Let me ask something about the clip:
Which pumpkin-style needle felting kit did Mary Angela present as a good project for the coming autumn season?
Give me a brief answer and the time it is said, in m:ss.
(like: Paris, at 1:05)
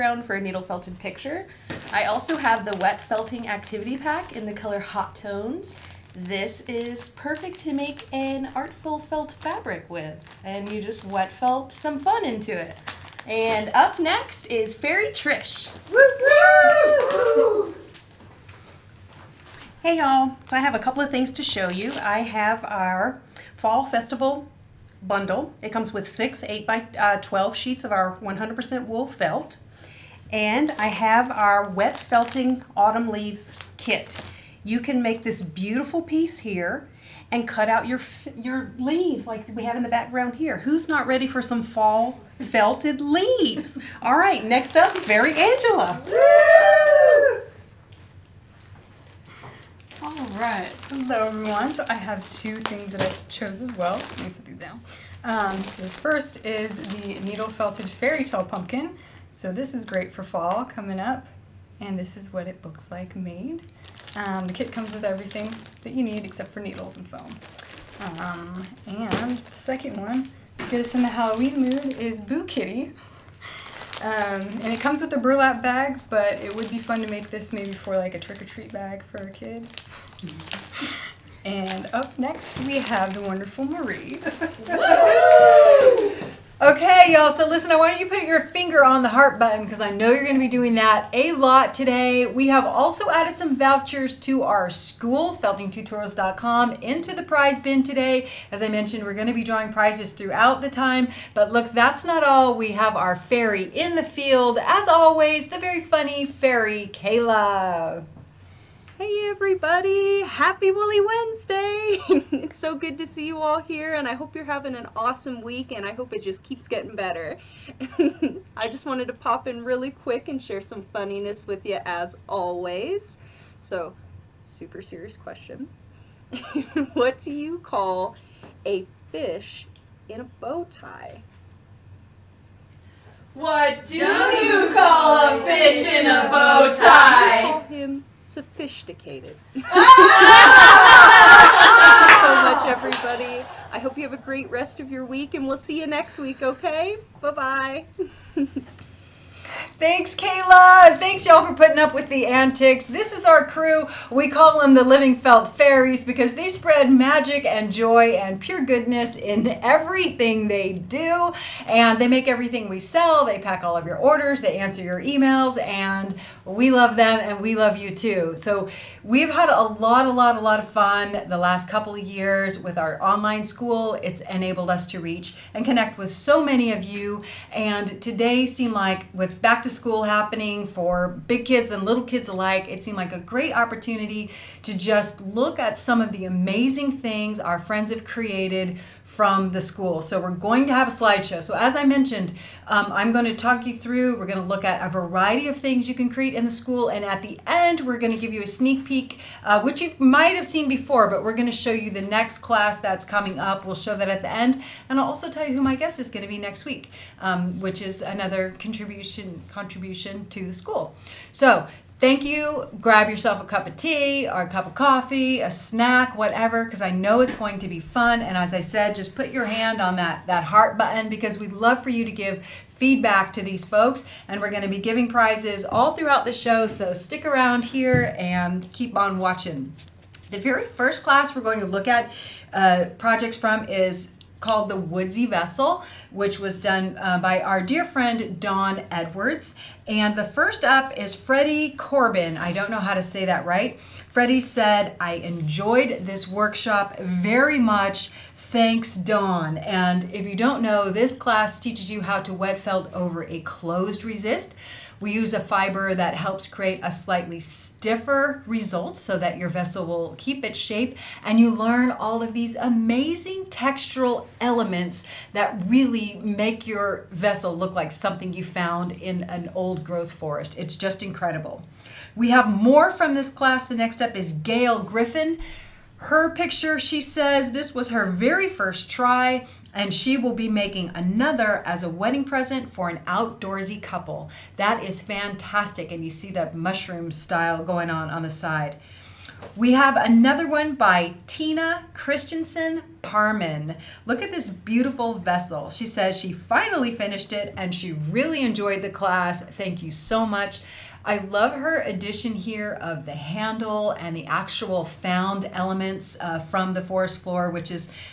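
Fairy tale pumpkin, at 0:57.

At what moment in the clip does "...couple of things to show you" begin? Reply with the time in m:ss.
0:20.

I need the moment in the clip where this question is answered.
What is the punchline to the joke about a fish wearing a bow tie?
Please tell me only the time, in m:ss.
2:18.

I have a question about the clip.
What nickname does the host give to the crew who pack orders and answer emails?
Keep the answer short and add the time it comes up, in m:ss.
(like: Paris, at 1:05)
Living Felt Fairies, at 2:34.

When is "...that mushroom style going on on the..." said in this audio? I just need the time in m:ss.
4:46.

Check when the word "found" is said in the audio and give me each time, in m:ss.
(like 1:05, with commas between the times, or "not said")
4:28, 5:04.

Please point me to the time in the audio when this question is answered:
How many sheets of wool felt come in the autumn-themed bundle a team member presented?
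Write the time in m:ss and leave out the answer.
0:26.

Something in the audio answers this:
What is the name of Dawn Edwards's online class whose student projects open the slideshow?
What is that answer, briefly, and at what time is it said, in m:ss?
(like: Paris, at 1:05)
The Woodsy Vessel, at 3:54.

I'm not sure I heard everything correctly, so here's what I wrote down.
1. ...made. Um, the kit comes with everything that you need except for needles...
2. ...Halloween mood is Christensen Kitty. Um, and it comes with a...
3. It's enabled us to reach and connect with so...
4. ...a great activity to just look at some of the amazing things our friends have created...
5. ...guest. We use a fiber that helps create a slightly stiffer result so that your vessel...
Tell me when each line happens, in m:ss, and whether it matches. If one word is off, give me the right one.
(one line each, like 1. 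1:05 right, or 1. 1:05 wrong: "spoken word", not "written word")
1. 1:03 right
2. 1:11 wrong: "Boo", not "Christensen"
3. 2:54 right
4. 3:03 wrong: "opportunity", not "activity"
5. 4:14 wrong: "resist", not "guest".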